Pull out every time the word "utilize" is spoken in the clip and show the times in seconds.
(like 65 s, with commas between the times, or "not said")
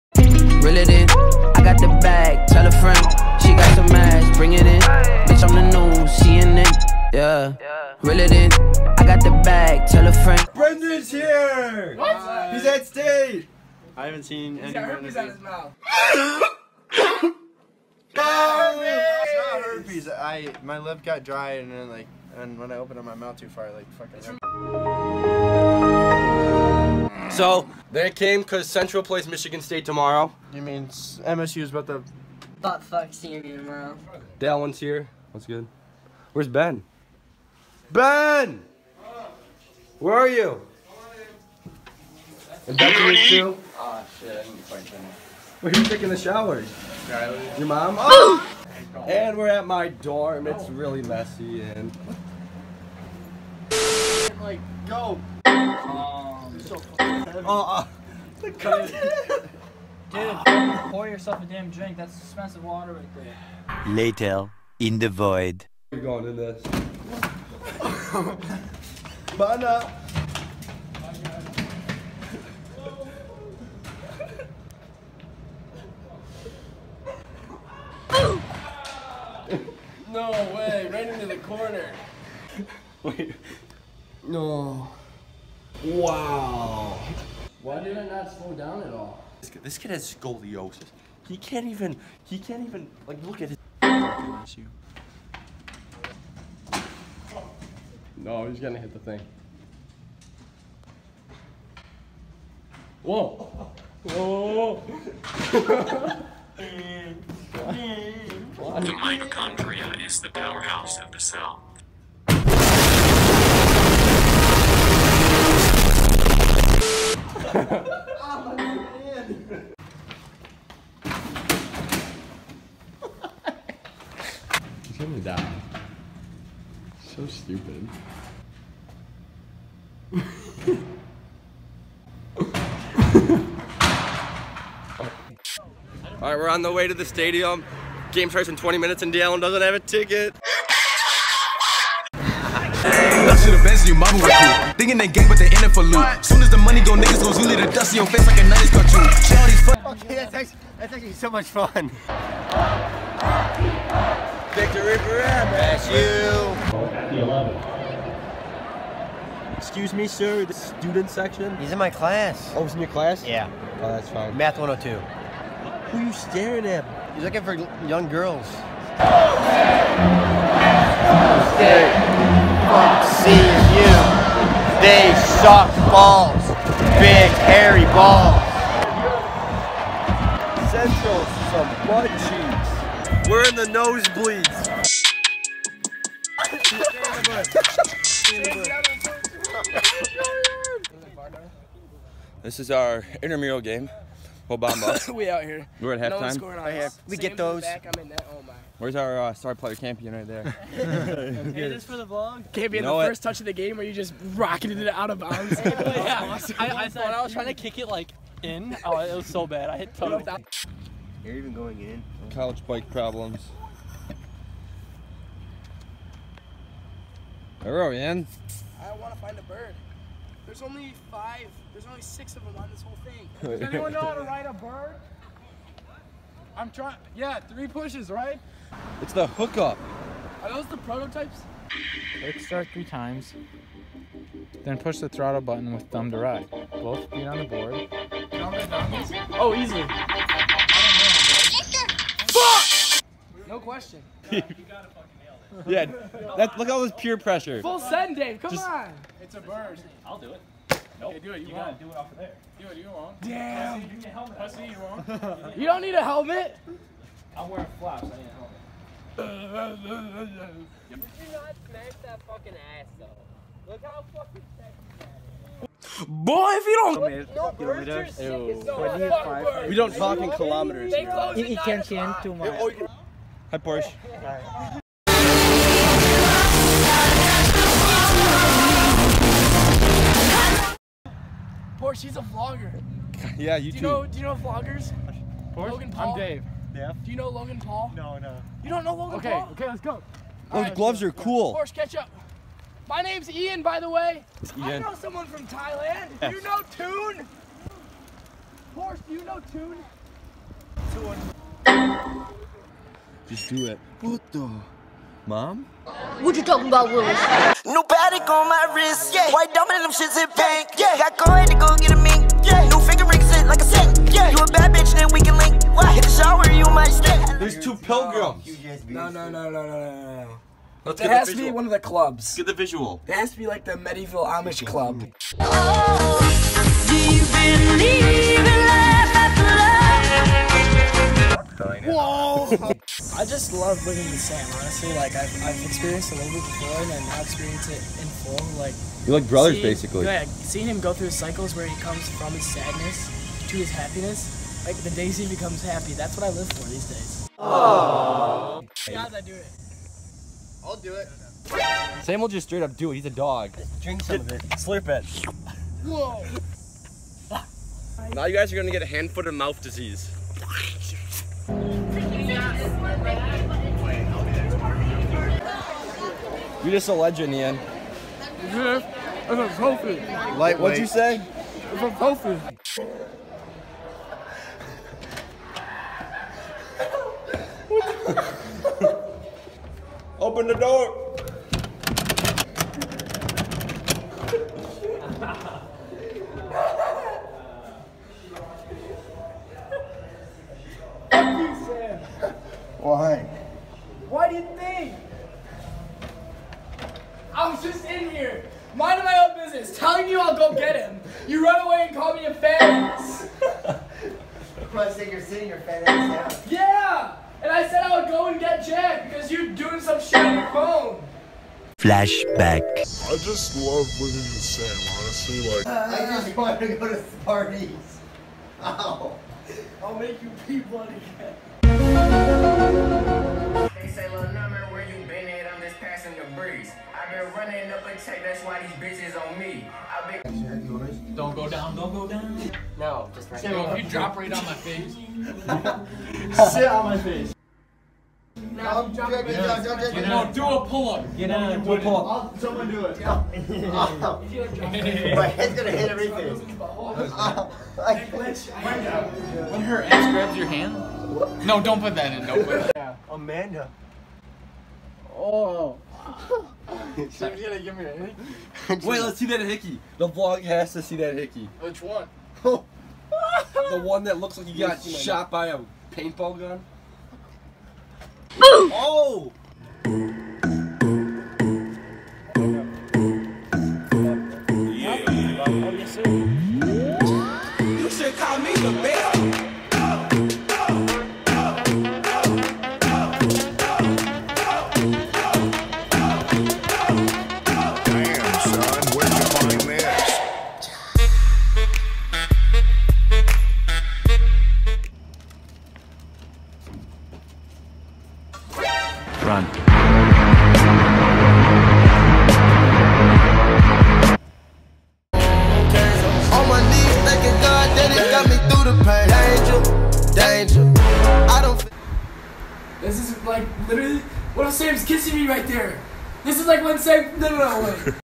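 not said.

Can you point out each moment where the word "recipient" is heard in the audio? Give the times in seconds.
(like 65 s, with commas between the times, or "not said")
not said.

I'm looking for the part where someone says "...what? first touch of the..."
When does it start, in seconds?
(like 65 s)
202 s.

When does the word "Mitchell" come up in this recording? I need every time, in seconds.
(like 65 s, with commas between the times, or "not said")
not said.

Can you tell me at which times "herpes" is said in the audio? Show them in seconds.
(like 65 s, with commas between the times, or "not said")
14 s, 19 s.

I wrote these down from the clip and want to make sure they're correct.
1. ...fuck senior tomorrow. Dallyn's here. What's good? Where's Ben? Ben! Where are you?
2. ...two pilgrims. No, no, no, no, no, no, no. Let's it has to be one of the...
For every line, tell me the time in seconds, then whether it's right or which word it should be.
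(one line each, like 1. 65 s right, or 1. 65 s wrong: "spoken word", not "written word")
1. 32 s right
2. 317 s right.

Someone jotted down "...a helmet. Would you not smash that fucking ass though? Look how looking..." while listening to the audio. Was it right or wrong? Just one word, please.
wrong.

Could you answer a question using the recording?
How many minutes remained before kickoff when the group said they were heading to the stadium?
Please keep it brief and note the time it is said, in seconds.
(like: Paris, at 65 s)
20, at 138 s.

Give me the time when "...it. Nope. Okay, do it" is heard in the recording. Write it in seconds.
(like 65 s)
250 s.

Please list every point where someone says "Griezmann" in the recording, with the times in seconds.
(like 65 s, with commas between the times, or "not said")
not said.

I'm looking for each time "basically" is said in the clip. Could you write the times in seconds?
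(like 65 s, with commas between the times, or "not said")
339 s.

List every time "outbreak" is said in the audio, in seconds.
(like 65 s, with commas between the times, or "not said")
not said.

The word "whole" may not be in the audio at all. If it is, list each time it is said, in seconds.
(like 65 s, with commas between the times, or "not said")
194 s, 222 s.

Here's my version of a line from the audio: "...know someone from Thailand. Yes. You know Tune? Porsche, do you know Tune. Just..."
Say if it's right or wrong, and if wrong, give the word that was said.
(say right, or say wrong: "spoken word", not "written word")
right.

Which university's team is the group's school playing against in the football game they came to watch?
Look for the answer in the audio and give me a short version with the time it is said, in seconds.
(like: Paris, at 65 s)
Michigan State, at 29 s.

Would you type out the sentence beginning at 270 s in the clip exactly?
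It, it can change too oh, much.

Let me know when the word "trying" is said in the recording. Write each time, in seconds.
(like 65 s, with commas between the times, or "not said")
207 s, 226 s.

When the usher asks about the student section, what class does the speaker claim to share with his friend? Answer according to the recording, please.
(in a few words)
Math 102.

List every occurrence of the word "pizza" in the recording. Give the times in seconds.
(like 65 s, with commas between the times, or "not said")
not said.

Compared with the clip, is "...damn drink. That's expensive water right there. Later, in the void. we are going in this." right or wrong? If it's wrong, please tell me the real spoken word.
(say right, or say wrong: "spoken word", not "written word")
right.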